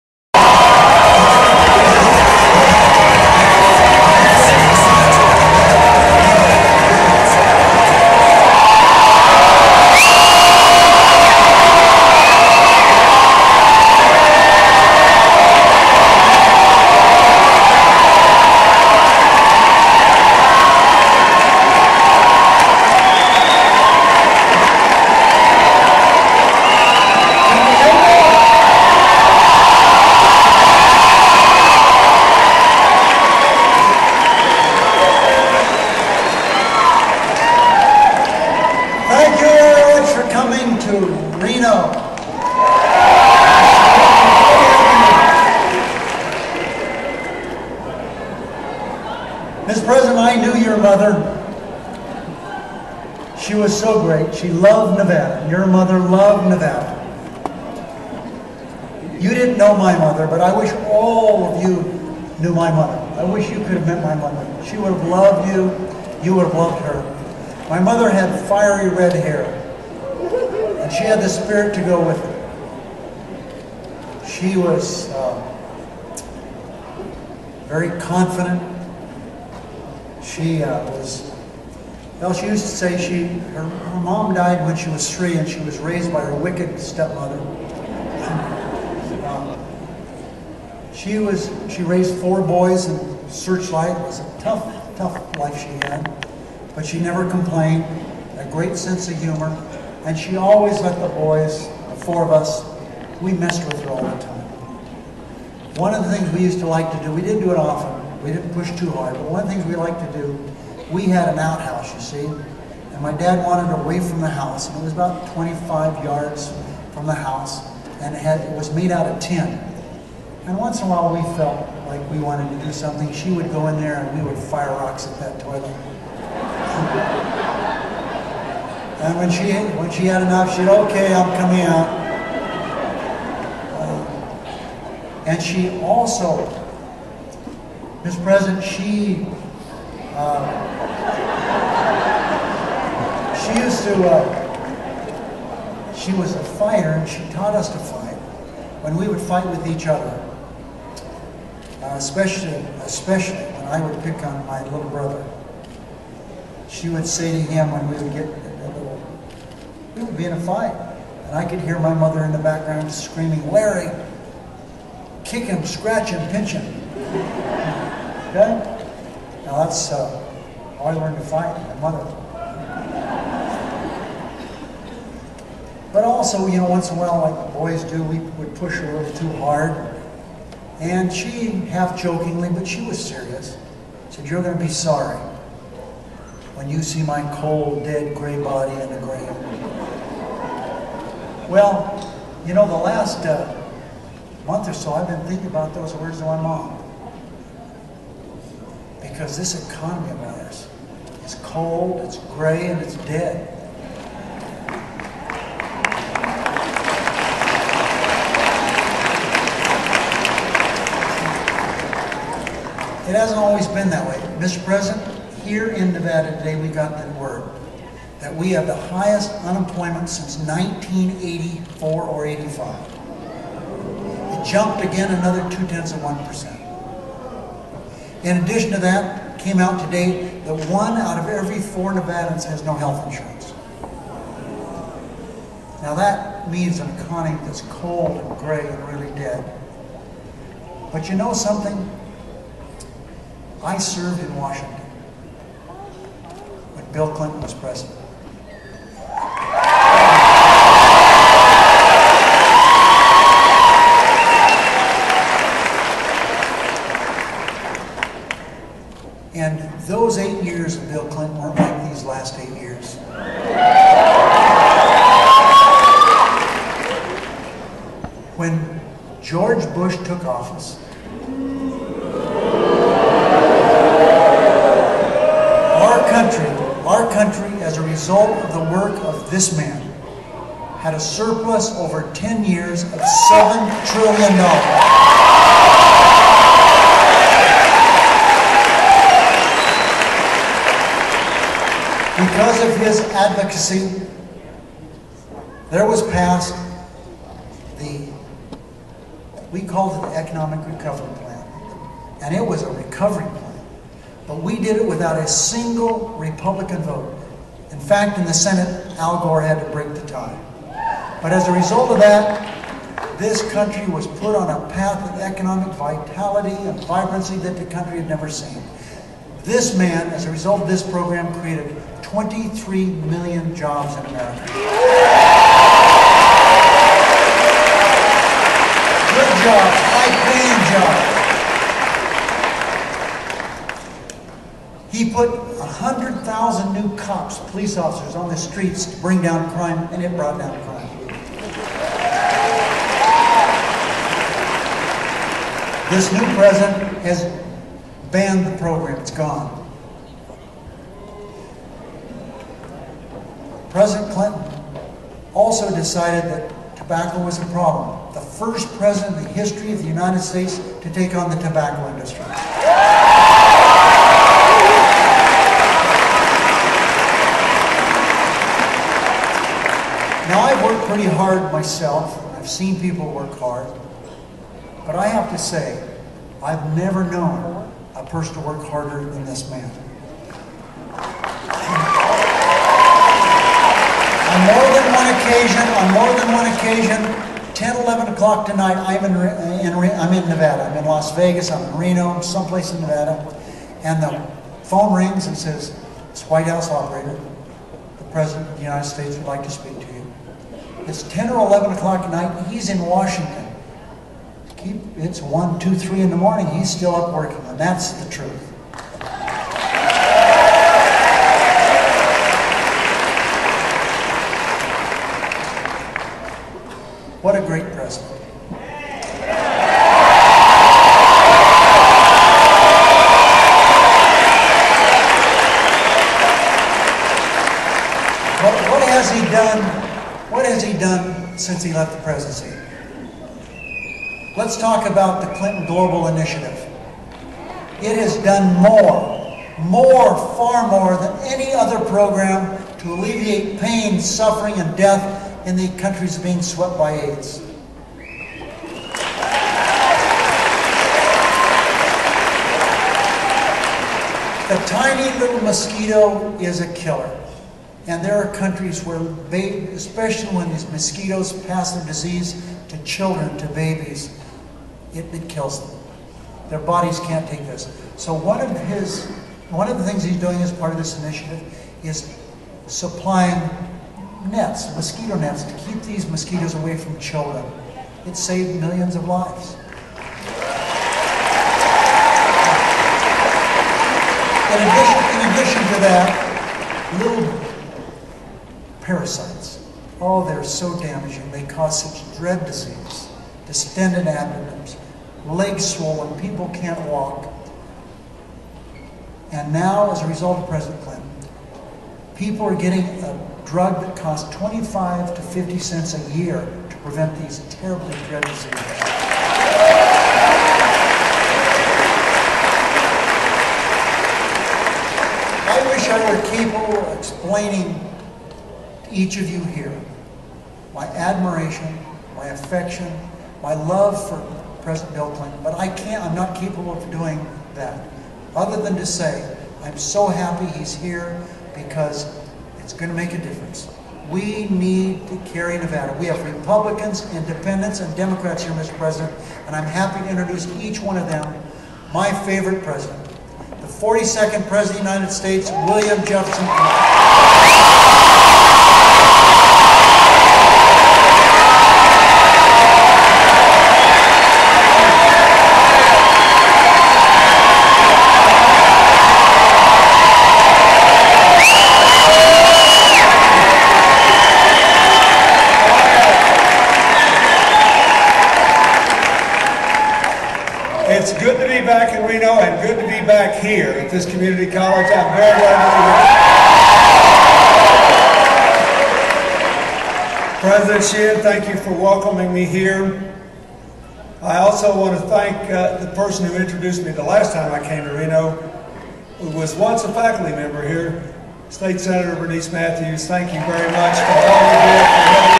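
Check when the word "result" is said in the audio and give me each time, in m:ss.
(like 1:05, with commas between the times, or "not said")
4:37, 5:11, 5:20, 8:20.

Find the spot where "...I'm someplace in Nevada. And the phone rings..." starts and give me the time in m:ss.
6:32.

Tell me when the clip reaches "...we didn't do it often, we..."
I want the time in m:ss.
1:47.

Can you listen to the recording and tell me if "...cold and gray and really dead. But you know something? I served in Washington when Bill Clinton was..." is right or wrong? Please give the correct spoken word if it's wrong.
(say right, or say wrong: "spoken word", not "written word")
right.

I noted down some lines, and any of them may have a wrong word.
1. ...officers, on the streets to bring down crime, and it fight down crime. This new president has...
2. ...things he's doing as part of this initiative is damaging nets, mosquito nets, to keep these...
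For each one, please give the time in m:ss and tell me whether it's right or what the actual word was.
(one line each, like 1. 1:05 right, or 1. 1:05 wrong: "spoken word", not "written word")
1. 5:37 wrong: "brought", not "fight"
2. 7:49 wrong: "supplying", not "damaging".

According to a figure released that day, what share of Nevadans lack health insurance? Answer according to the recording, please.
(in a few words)
one out of every four.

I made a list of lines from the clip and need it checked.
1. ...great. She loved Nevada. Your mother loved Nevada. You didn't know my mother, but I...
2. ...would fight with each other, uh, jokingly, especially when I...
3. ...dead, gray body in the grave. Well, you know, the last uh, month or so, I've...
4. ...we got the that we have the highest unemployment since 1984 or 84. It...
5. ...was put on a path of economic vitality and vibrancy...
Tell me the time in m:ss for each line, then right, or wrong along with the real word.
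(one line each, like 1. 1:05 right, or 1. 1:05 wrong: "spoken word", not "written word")
1. 0:54 right
2. 2:29 wrong: "especially", not "jokingly"
3. 3:07 right
4. 3:36 wrong: "85", not "84"
5. 5:13 right.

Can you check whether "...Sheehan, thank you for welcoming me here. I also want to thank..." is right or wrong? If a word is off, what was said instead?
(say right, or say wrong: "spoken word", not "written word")
right.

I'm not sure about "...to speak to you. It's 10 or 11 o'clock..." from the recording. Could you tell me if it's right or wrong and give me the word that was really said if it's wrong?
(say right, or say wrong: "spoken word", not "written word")
right.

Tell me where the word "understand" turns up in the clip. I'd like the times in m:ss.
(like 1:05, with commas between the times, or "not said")
not said.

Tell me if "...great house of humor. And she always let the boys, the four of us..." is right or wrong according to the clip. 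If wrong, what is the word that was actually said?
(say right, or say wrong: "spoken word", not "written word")
wrong: "sense", not "house".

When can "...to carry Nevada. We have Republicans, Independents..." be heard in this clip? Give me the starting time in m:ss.
8:55.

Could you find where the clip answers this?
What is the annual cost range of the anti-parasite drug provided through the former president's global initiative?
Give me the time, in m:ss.
8:24.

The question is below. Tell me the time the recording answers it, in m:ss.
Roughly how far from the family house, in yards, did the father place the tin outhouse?
1:55.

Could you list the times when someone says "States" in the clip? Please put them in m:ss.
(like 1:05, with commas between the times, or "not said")
6:00, 6:38, 9:05, 9:51.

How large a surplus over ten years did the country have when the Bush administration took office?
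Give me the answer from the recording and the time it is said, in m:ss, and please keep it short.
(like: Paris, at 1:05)
$7 trillion, at 4:42.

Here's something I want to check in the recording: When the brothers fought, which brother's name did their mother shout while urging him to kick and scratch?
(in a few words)
Larry.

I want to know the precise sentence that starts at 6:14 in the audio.
But I have to say, I've never known a person to work harder than this man.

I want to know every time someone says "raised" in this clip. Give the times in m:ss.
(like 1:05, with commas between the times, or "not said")
1:25, 1:31.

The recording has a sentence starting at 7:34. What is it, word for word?
The tiny little mosquito is a killer.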